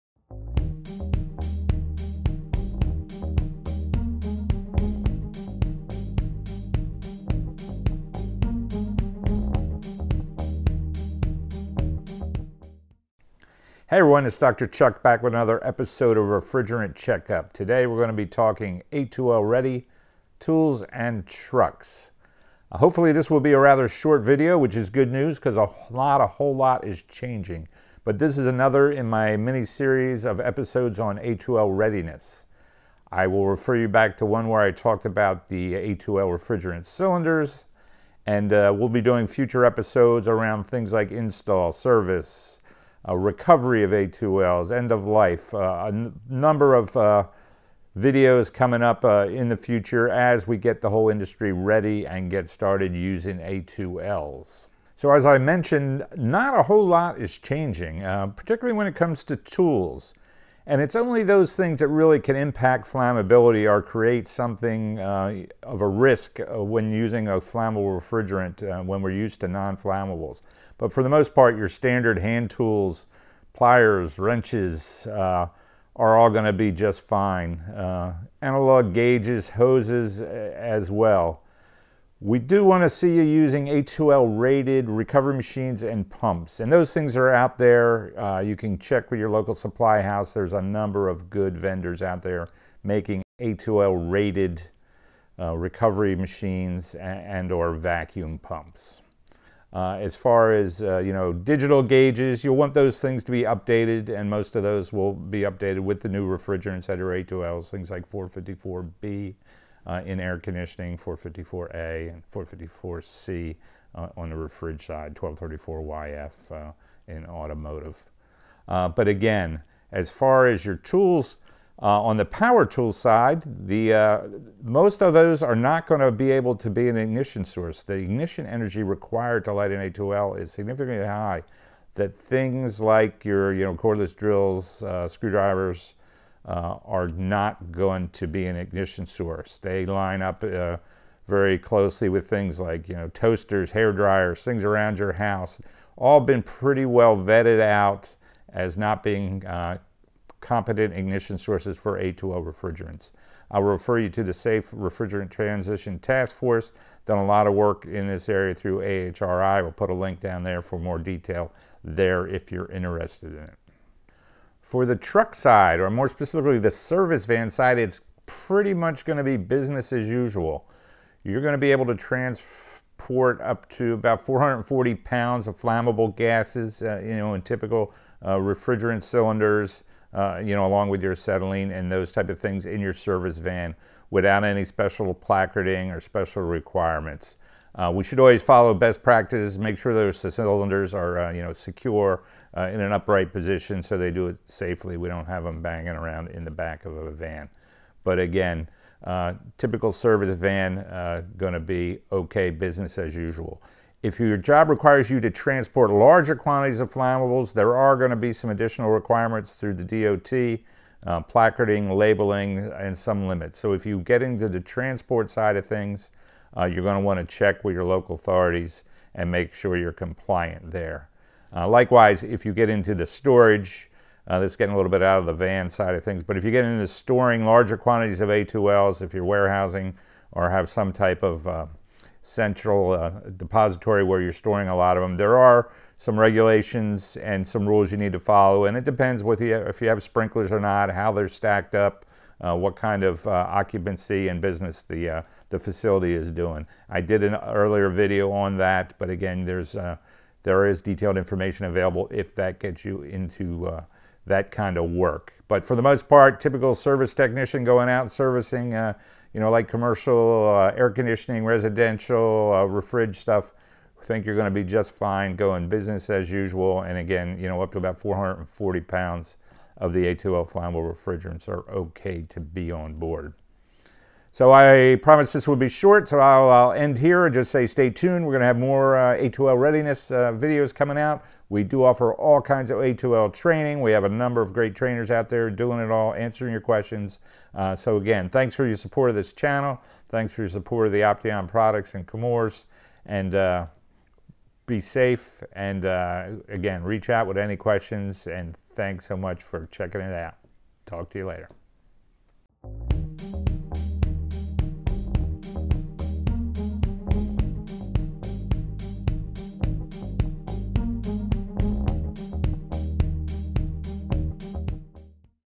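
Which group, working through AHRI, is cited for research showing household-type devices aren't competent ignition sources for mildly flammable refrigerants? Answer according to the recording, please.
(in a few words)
Safe Refrigerant Transition Task Force.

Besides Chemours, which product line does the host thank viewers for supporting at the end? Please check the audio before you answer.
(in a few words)
Opteon.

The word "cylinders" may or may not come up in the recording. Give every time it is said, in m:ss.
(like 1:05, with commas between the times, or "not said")
0:36, 2:59, 3:10.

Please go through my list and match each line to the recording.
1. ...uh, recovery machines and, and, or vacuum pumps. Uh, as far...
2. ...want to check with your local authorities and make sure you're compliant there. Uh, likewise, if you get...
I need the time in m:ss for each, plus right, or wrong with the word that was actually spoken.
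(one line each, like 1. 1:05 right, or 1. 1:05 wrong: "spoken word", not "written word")
1. 1:35 right
2. 3:37 right.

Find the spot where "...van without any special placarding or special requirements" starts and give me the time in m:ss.
3:03.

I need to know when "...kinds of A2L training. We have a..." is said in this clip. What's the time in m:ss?
4:42.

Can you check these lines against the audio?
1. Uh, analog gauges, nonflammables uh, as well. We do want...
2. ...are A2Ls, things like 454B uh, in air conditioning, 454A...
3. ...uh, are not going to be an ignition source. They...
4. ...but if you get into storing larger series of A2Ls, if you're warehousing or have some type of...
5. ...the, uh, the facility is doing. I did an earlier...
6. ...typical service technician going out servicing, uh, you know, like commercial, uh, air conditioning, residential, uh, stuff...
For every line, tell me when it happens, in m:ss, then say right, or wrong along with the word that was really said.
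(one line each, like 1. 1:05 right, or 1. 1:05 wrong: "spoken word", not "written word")
1. 1:17 wrong: "hoses", not "nonflammables"
2. 1:46 right
3. 2:16 right
4. 3:46 wrong: "quantities", not "series"
5. 4:04 right
6. 4:16 right.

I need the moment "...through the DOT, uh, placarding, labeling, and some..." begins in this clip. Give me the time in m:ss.
3:29.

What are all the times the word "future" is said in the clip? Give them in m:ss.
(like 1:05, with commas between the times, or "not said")
0:39, 0:49.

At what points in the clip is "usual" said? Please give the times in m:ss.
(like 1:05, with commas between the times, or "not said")
2:50, 3:23, 4:26.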